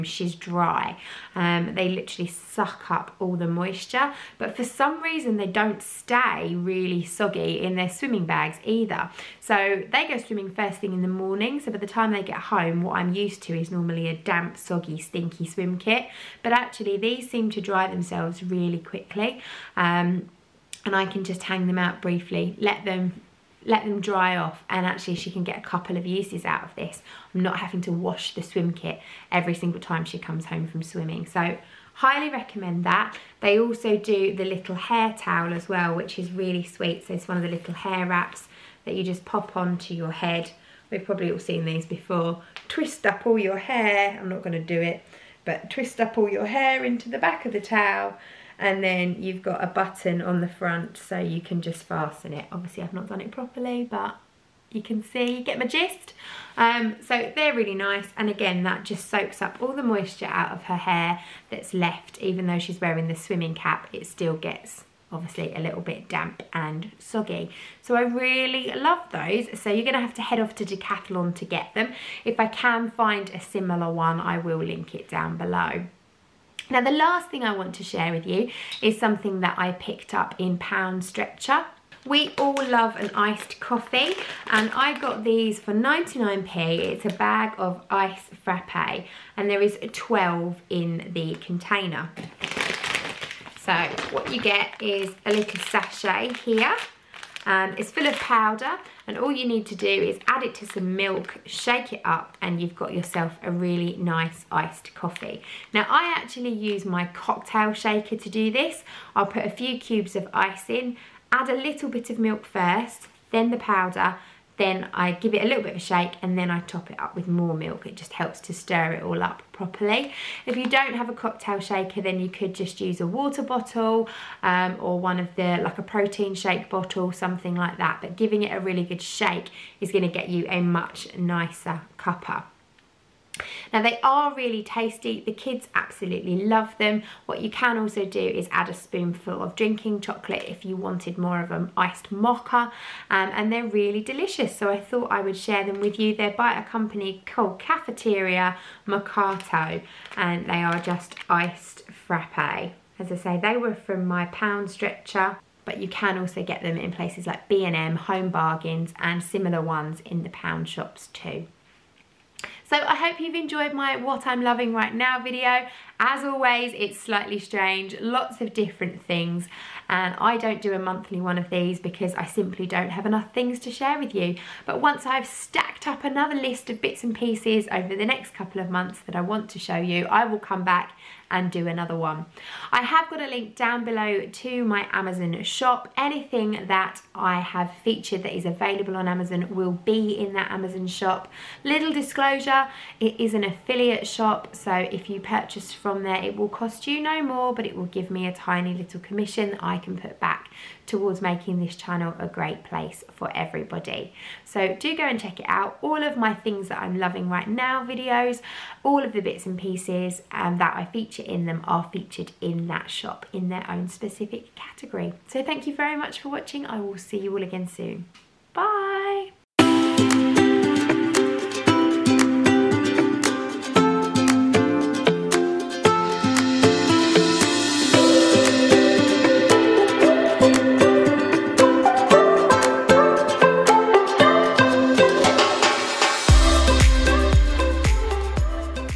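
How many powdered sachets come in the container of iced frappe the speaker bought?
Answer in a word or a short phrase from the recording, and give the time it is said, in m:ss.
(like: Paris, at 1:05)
12, at 1:29.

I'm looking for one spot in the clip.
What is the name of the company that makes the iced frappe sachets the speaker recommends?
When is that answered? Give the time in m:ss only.
2:27.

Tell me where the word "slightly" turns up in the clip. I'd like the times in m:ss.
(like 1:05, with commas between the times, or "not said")
2:46.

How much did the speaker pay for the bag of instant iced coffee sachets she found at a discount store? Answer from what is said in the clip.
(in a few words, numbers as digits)
99p.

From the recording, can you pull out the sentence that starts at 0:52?
Obviously I've not done it properly but you can see, you get my gist.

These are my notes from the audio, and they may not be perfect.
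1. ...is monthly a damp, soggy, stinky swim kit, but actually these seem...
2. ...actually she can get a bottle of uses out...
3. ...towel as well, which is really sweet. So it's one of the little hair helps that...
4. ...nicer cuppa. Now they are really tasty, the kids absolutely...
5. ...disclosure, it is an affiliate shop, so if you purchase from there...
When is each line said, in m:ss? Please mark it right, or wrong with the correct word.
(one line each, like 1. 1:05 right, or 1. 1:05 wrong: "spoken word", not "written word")
1. 0:13 wrong: "normally", not "monthly"
2. 0:24 wrong: "couple", not "bottle"
3. 0:35 wrong: "wraps", not "helps"
4. 2:11 right
5. 3:11 right.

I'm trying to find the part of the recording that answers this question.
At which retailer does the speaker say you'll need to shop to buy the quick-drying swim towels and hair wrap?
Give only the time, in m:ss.
1:10.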